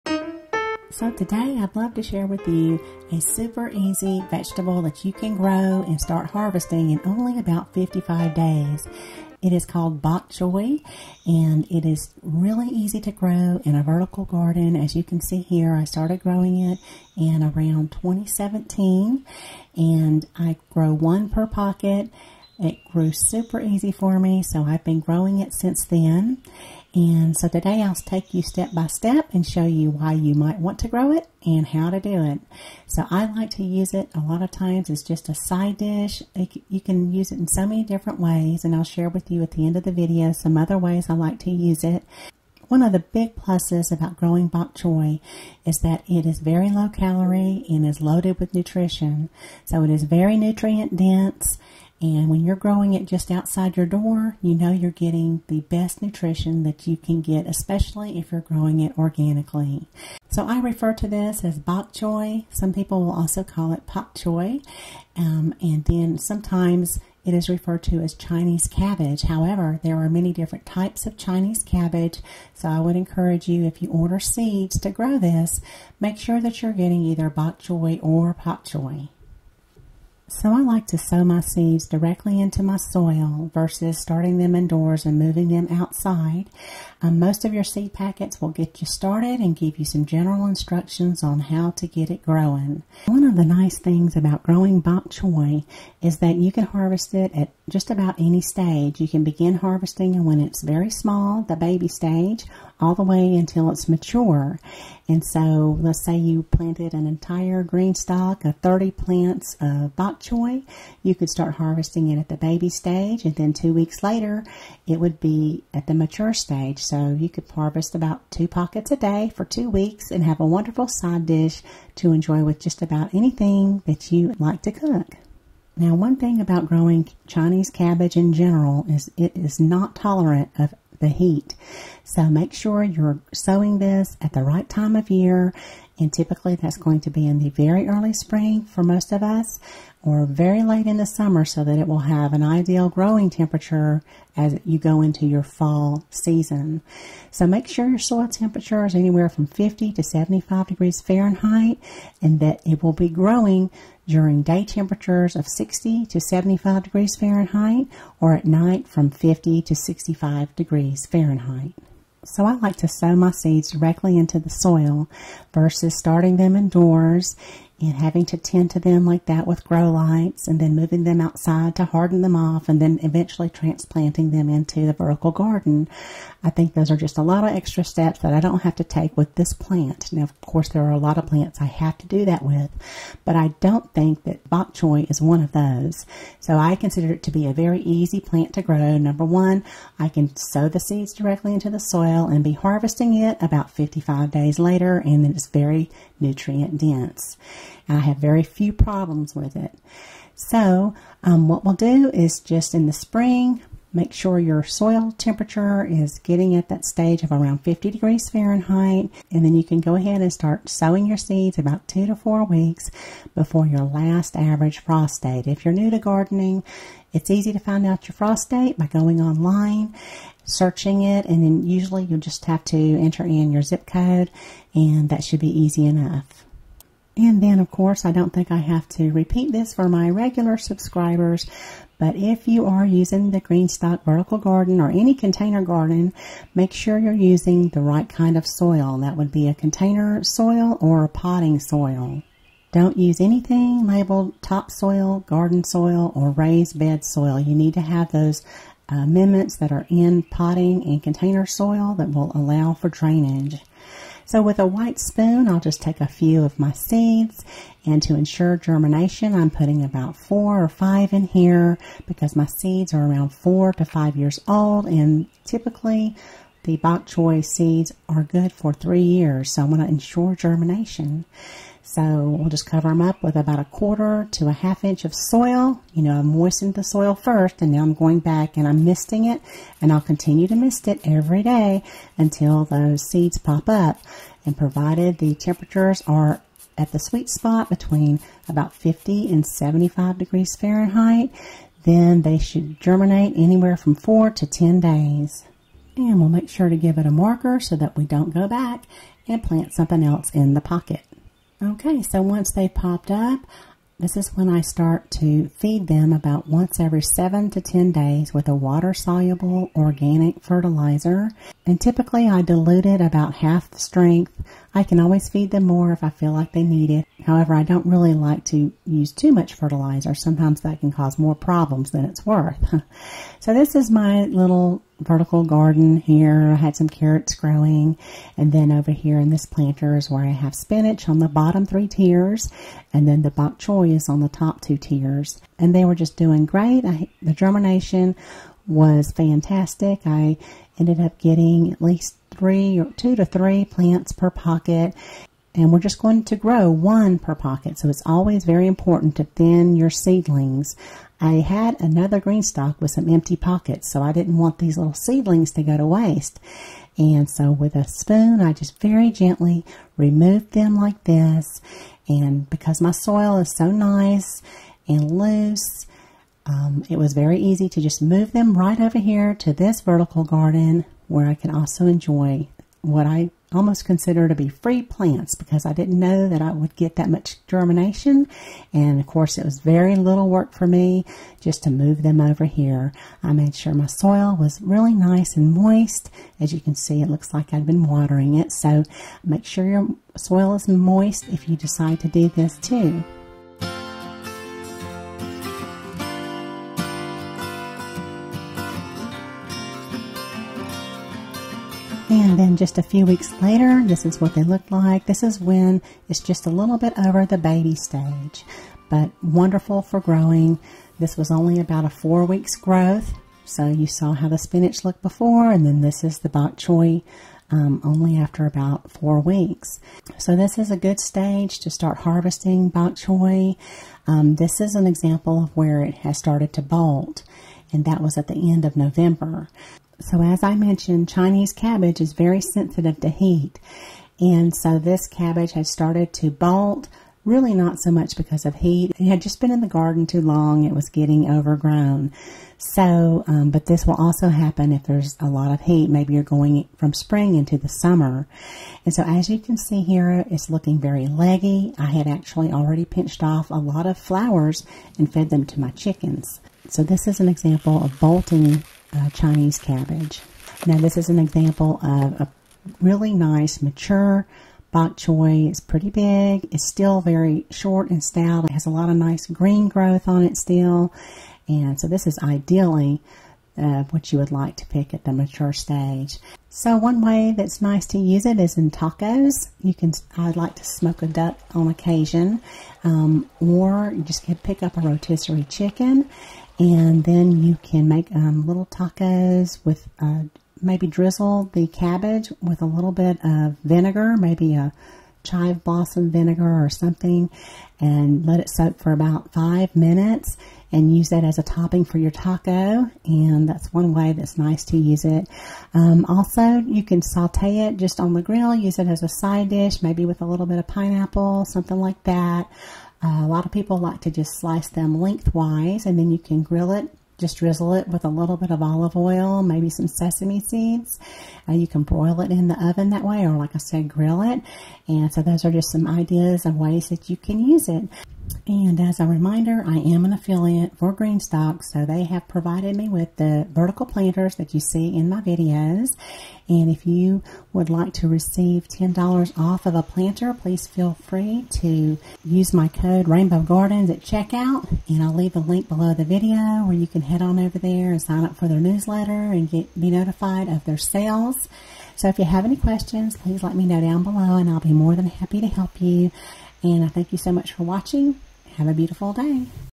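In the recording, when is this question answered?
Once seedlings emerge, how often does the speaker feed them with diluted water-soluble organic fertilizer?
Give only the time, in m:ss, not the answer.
5:06.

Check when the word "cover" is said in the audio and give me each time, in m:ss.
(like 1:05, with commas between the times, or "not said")
4:32.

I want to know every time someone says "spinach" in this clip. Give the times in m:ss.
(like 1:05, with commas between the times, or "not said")
5:30, 6:54.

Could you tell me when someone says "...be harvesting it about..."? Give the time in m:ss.
3:12.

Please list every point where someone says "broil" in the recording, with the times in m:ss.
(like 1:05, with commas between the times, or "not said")
8:41.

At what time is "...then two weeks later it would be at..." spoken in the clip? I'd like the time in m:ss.
1:53.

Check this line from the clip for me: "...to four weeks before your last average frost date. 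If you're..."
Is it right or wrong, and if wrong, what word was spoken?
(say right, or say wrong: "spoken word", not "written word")
right.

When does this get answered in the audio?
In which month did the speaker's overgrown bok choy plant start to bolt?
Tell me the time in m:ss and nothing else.
7:08.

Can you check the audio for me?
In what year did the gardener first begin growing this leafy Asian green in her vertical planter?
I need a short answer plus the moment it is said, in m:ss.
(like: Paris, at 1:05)
2017, at 0:17.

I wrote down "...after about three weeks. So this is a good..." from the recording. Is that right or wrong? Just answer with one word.
wrong.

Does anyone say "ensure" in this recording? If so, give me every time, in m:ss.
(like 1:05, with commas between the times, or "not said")
4:18, 4:29.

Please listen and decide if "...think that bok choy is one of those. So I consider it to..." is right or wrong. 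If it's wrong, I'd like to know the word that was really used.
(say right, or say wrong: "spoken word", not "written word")
right.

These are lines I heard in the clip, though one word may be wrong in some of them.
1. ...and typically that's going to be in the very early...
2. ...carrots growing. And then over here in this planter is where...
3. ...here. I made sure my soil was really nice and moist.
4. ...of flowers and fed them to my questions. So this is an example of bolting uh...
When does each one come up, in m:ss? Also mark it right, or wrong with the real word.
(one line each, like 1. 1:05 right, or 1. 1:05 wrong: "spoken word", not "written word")
1. 2:16 right
2. 5:26 right
3. 6:22 right
4. 7:33 wrong: "chickens", not "questions".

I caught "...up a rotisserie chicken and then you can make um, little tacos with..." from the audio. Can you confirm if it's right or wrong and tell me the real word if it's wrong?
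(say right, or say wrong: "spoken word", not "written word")
right.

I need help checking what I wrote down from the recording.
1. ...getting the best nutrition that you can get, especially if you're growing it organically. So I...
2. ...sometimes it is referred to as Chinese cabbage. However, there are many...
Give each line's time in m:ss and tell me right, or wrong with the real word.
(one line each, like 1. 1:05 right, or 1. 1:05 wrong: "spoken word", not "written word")
1. 0:54 right
2. 1:06 right.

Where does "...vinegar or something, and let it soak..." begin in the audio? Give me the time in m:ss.
8:16.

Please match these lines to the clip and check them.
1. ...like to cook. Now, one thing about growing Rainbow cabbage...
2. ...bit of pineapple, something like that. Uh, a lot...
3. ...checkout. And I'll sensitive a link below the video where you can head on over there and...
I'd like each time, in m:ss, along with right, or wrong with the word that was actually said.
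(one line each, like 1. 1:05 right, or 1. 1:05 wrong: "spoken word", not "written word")
1. 2:04 wrong: "Chinese", not "Rainbow"
2. 8:30 right
3. 9:04 wrong: "leave", not "sensitive".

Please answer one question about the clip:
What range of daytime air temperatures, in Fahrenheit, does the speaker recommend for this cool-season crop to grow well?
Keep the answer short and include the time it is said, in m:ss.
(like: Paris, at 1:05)
60 to 75 degrees, at 2:35.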